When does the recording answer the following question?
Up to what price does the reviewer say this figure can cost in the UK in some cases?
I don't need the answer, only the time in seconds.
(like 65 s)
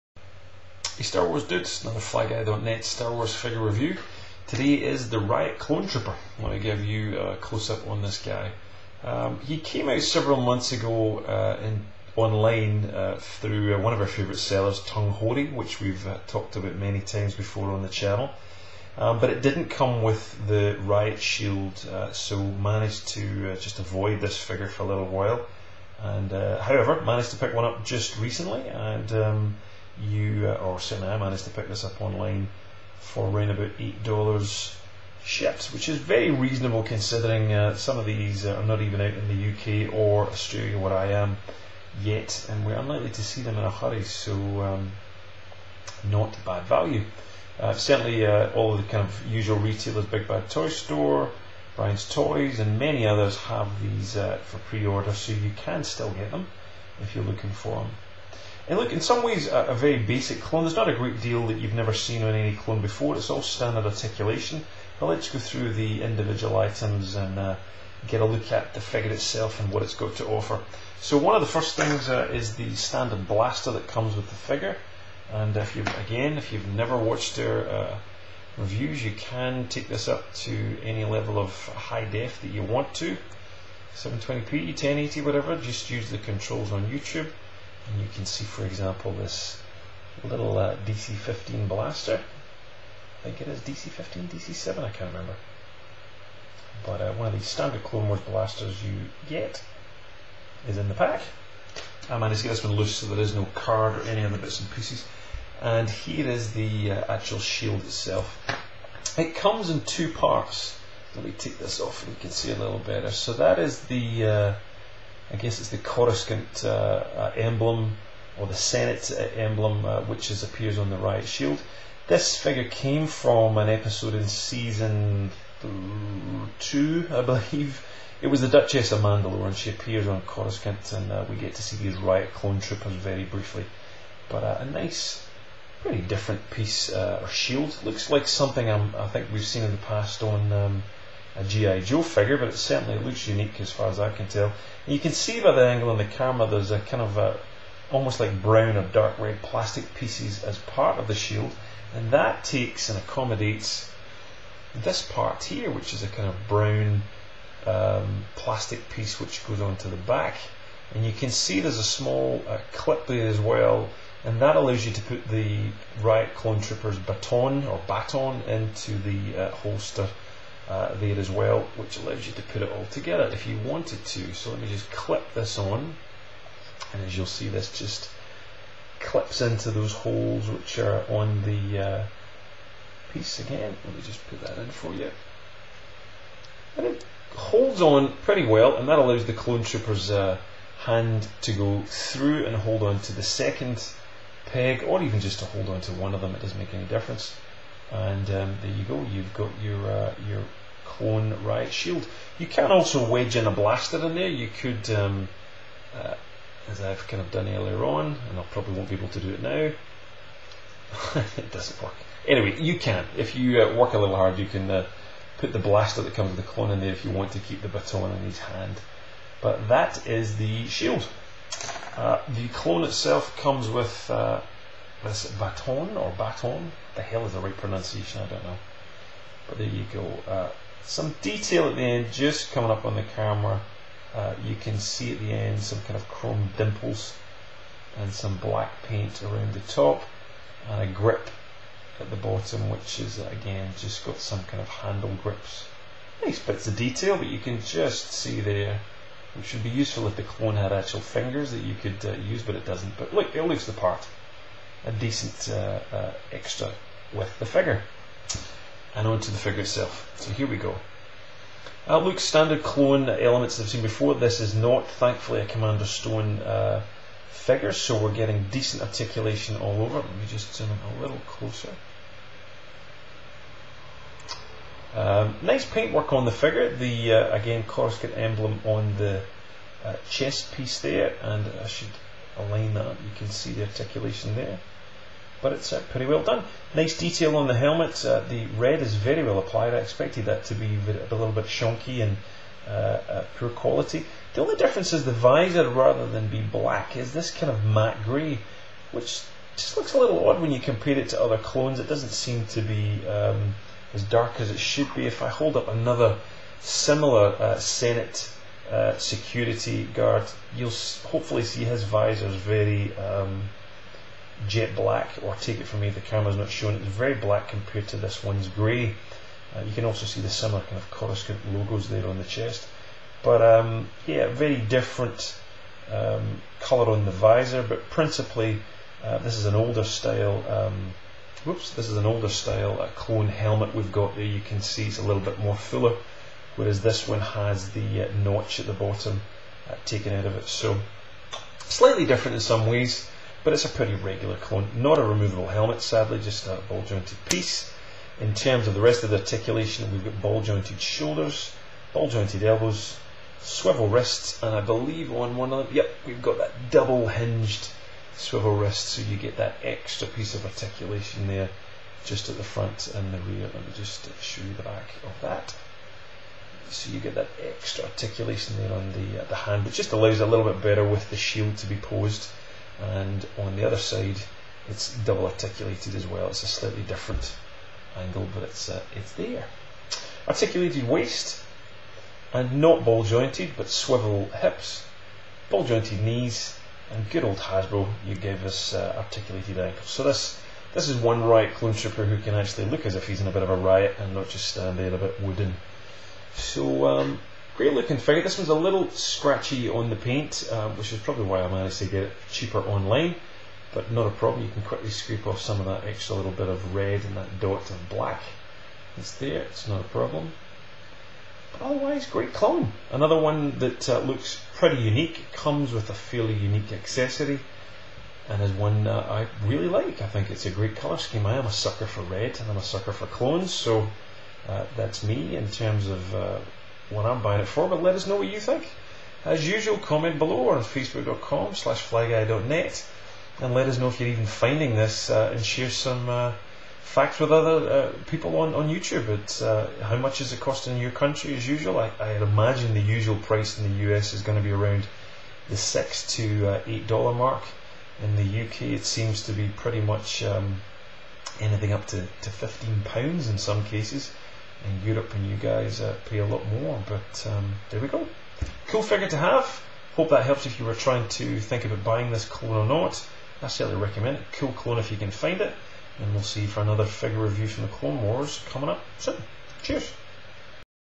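452 s.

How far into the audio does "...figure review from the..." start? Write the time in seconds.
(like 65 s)
466 s.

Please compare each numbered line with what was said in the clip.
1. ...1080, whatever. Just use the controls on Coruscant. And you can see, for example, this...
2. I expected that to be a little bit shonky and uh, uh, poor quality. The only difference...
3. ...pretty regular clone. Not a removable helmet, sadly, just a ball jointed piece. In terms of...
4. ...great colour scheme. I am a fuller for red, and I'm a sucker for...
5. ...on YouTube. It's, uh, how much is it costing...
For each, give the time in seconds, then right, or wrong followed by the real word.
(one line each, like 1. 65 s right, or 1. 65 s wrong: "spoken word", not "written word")
1. 84 s wrong: "YouTube", not "Coruscant"
2. 289 s right
3. 343 s right
4. 420 s wrong: "sucker", not "fuller"
5. 438 s right.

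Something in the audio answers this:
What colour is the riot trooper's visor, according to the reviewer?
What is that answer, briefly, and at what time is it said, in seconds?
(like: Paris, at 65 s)
matte grey, at 297 s.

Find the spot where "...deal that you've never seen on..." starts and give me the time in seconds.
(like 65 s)
61 s.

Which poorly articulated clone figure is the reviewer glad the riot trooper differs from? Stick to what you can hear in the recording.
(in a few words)
Commander Stone.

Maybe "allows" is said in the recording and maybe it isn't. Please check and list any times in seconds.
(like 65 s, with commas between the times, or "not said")
164 s, 171 s, 188 s, 369 s.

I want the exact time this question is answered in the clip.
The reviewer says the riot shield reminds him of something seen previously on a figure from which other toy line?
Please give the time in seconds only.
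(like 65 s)
141 s.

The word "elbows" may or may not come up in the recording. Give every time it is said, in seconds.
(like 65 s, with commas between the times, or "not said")
352 s.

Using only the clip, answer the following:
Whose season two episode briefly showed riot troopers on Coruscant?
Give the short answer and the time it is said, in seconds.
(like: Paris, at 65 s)
Duchess of Mandalore, at 128 s.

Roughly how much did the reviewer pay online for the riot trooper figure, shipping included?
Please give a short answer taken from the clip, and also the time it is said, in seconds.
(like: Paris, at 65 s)
$8, at 33 s.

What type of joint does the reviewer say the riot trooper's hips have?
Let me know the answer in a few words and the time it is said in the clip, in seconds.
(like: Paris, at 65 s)
swivel hips, at 383 s.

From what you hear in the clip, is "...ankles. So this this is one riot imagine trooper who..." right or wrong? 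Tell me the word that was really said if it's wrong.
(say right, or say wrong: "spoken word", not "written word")
wrong: "clone", not "imagine".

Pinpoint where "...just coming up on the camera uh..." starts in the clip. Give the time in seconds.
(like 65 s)
232 s.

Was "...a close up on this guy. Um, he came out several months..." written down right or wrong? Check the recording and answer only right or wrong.
right.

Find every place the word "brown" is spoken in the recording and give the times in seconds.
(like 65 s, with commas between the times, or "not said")
148 s, 156 s.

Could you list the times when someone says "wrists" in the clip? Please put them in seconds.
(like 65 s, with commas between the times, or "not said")
353 s, 358 s.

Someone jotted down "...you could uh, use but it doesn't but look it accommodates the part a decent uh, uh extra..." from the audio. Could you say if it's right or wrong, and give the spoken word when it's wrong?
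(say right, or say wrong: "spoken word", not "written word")
wrong: "leaves", not "accommodates".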